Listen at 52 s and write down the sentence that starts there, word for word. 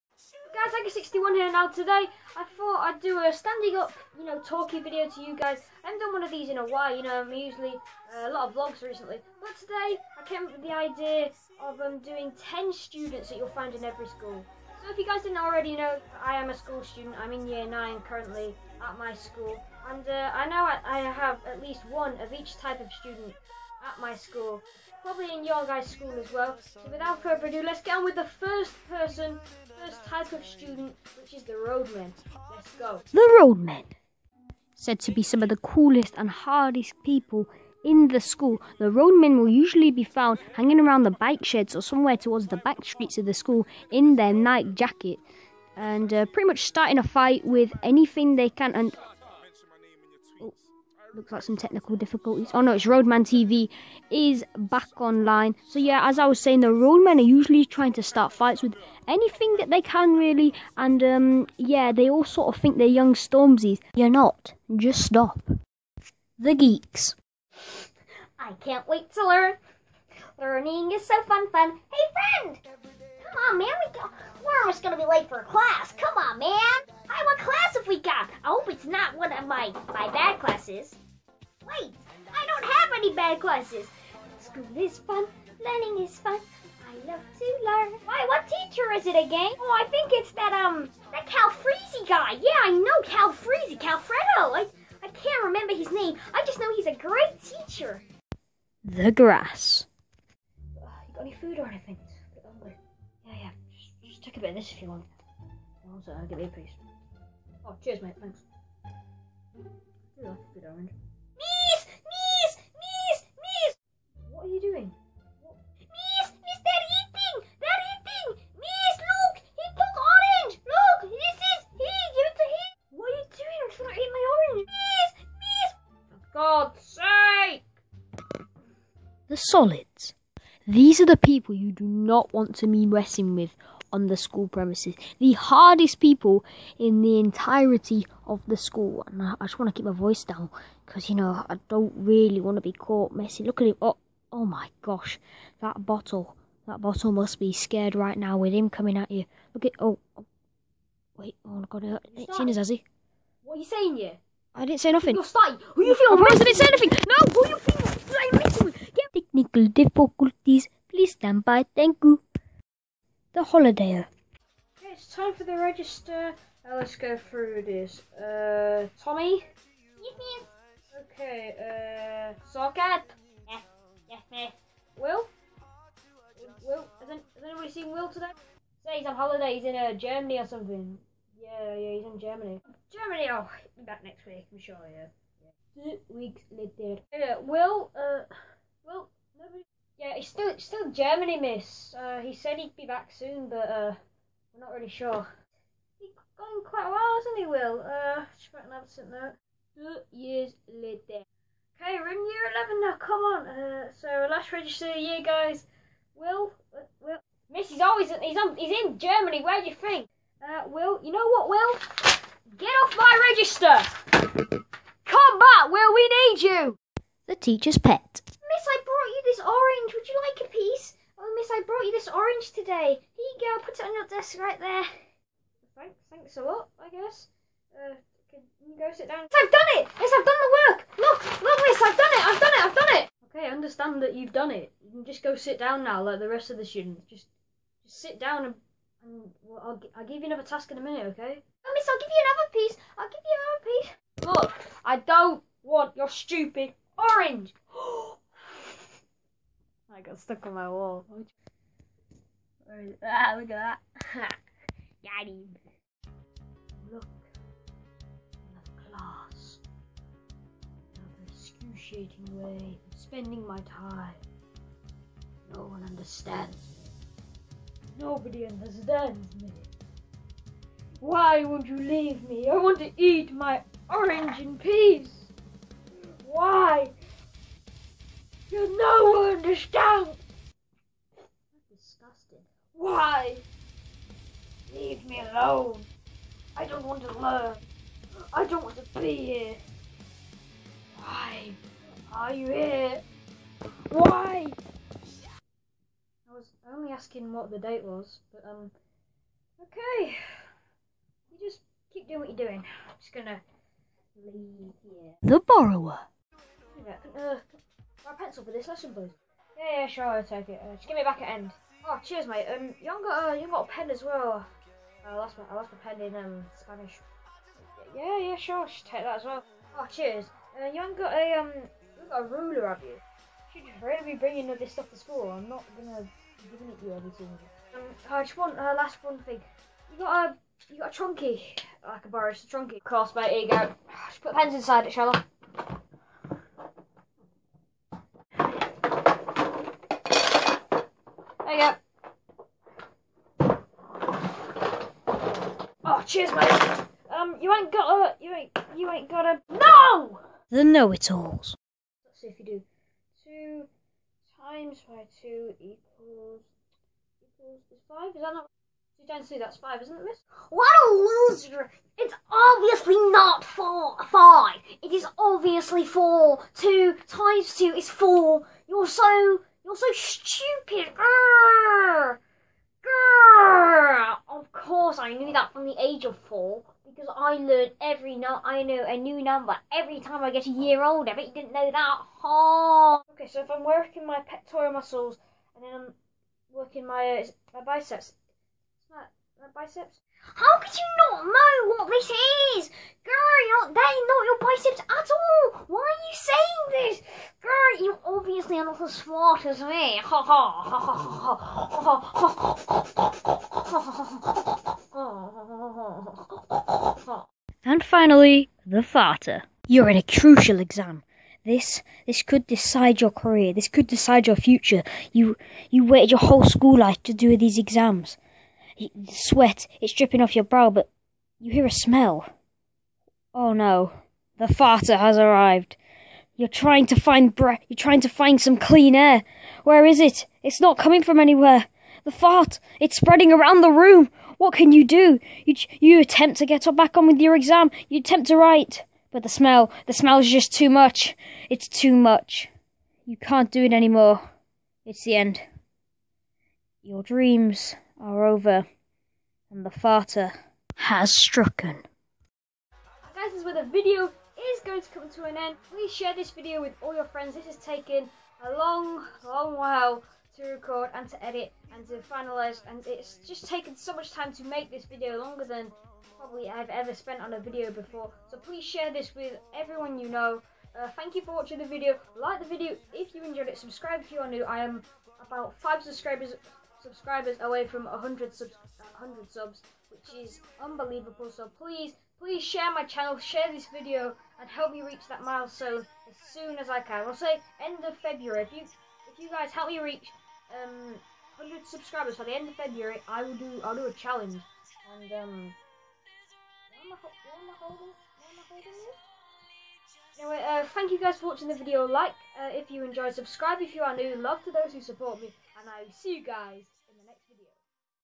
Oh no, it's Roadman TV is back online.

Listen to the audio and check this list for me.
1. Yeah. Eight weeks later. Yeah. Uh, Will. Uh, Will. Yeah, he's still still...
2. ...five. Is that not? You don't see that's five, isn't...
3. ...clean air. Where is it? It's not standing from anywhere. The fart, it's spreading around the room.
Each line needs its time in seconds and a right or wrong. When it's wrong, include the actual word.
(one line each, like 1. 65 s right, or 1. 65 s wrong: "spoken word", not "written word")
1. 184 s wrong: "Two", not "Eight"
2. 357 s right
3. 428 s wrong: "coming", not "standing".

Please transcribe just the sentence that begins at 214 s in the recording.
Come back, Will, we need you!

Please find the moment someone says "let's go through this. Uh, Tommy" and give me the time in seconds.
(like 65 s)
166 s.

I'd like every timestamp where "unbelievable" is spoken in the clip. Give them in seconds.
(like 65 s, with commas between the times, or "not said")
480 s.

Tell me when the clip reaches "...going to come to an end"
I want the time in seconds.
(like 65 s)
454 s.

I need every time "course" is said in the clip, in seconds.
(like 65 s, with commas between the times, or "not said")
332 s, 374 s.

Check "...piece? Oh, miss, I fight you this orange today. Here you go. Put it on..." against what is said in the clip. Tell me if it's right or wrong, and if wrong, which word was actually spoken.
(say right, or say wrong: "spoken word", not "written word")
wrong: "brought", not "fight".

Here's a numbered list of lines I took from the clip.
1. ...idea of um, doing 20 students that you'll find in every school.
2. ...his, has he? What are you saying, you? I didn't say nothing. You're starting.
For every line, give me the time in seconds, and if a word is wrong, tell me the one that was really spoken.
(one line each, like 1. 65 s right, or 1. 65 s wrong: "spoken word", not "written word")
1. 10 s wrong: "10", not "20"
2. 152 s right.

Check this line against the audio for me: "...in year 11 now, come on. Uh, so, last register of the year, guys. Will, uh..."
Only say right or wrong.
right.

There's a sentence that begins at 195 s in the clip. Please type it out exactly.
He's gone quite a while, hasn't he, Will?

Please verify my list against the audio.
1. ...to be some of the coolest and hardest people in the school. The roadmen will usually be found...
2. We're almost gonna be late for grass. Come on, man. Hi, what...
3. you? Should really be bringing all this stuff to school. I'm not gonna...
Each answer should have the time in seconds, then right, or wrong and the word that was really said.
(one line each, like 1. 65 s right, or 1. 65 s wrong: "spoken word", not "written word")
1. 35 s right
2. 74 s wrong: "class", not "grass"
3. 323 s right.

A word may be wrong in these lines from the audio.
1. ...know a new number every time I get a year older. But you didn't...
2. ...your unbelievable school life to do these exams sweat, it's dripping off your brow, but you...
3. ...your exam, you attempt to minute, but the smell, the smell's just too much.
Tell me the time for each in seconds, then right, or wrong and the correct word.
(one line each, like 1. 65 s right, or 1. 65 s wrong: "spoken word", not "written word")
1. 378 s right
2. 416 s wrong: "whole", not "unbelievable"
3. 437 s wrong: "write", not "minute".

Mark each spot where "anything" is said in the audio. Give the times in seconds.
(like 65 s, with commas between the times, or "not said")
47 s, 59 s, 101 s, 156 s.